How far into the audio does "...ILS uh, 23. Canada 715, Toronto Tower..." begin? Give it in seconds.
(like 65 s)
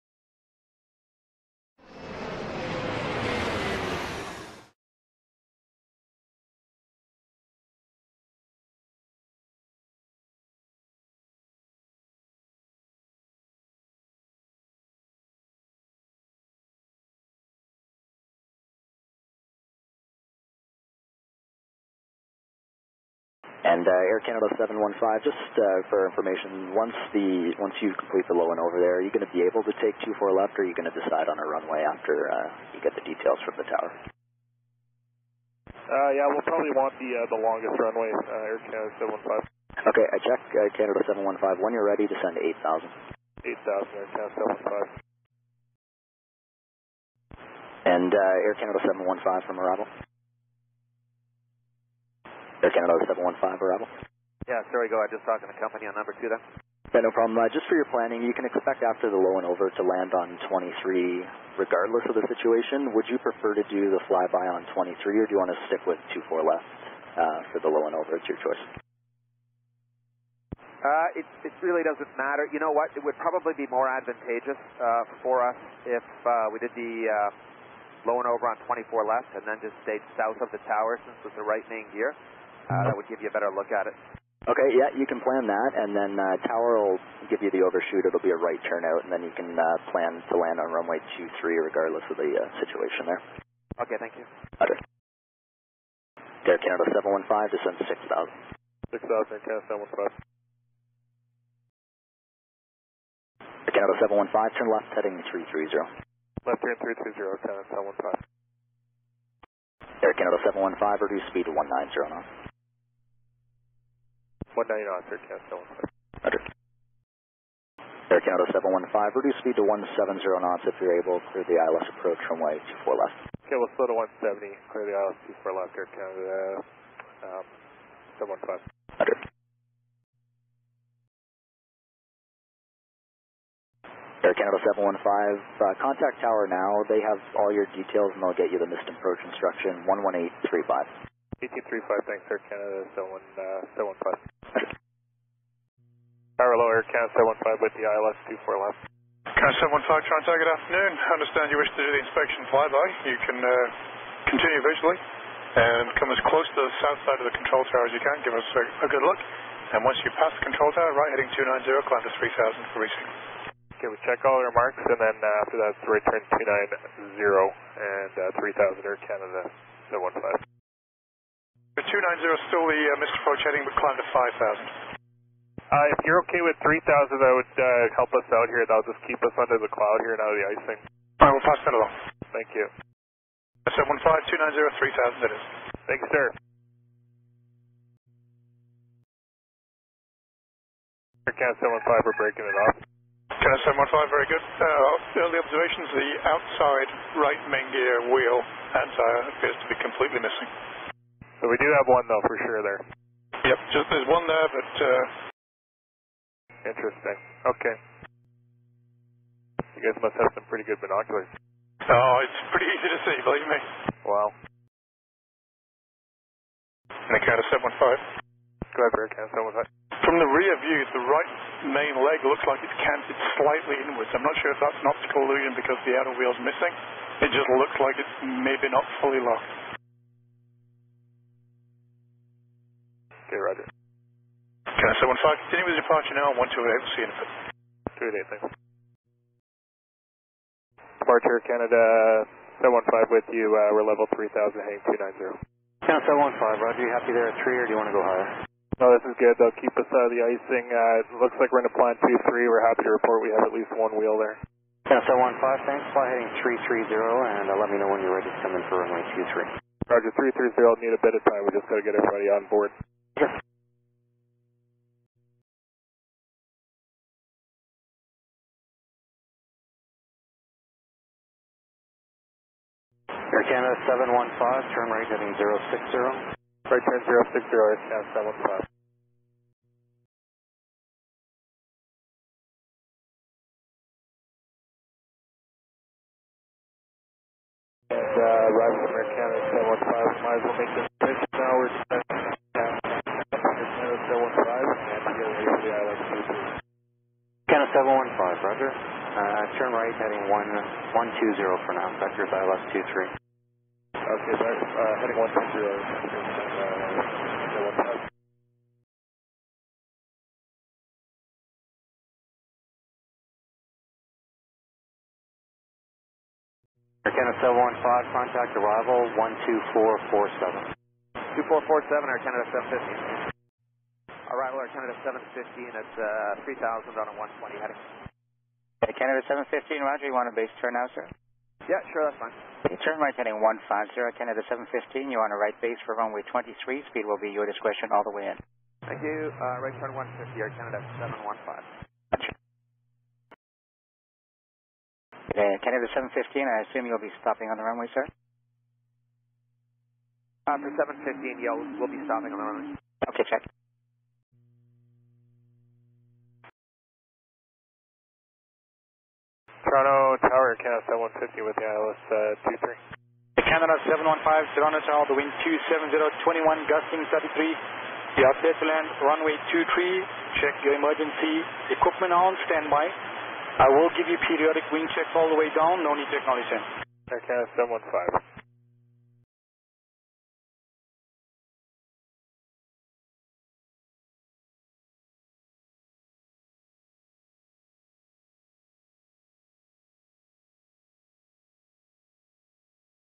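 361 s.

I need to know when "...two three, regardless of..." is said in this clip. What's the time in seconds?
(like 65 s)
91 s.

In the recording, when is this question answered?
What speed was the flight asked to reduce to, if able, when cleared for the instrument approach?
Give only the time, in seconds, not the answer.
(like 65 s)
119 s.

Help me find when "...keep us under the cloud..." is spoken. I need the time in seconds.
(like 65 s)
179 s.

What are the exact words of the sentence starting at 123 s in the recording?
Okay, we'll slow to 170, clear the ILS 24 left, air count uh, um, 715.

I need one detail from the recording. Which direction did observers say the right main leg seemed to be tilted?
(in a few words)
inwards.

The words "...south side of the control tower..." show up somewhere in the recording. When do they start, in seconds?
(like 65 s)
156 s.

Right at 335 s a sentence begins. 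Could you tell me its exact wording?
You're on a right base for runway 23.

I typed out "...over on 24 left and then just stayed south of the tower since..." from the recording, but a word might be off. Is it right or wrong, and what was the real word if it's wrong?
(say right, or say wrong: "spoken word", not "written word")
right.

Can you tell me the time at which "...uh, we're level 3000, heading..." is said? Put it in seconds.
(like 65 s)
243 s.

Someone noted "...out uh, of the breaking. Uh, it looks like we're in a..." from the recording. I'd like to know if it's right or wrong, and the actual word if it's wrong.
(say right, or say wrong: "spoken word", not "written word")
wrong: "icing", not "breaking".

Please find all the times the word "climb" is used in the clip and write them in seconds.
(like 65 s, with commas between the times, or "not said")
161 s, 173 s.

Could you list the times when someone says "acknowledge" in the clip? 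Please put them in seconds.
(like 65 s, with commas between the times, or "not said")
376 s.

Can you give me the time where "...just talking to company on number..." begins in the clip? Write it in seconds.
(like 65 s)
55 s.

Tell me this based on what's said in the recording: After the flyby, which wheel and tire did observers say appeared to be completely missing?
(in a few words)
outside right main gear.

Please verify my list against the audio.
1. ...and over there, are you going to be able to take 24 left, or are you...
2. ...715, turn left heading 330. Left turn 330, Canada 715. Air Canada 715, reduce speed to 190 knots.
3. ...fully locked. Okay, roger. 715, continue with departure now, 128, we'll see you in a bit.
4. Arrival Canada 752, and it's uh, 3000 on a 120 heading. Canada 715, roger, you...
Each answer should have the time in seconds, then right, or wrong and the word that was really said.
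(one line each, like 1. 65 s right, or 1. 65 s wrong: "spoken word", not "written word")
1. 28 s right
2. 104 s right
3. 229 s right
4. 324 s wrong: "750", not "752".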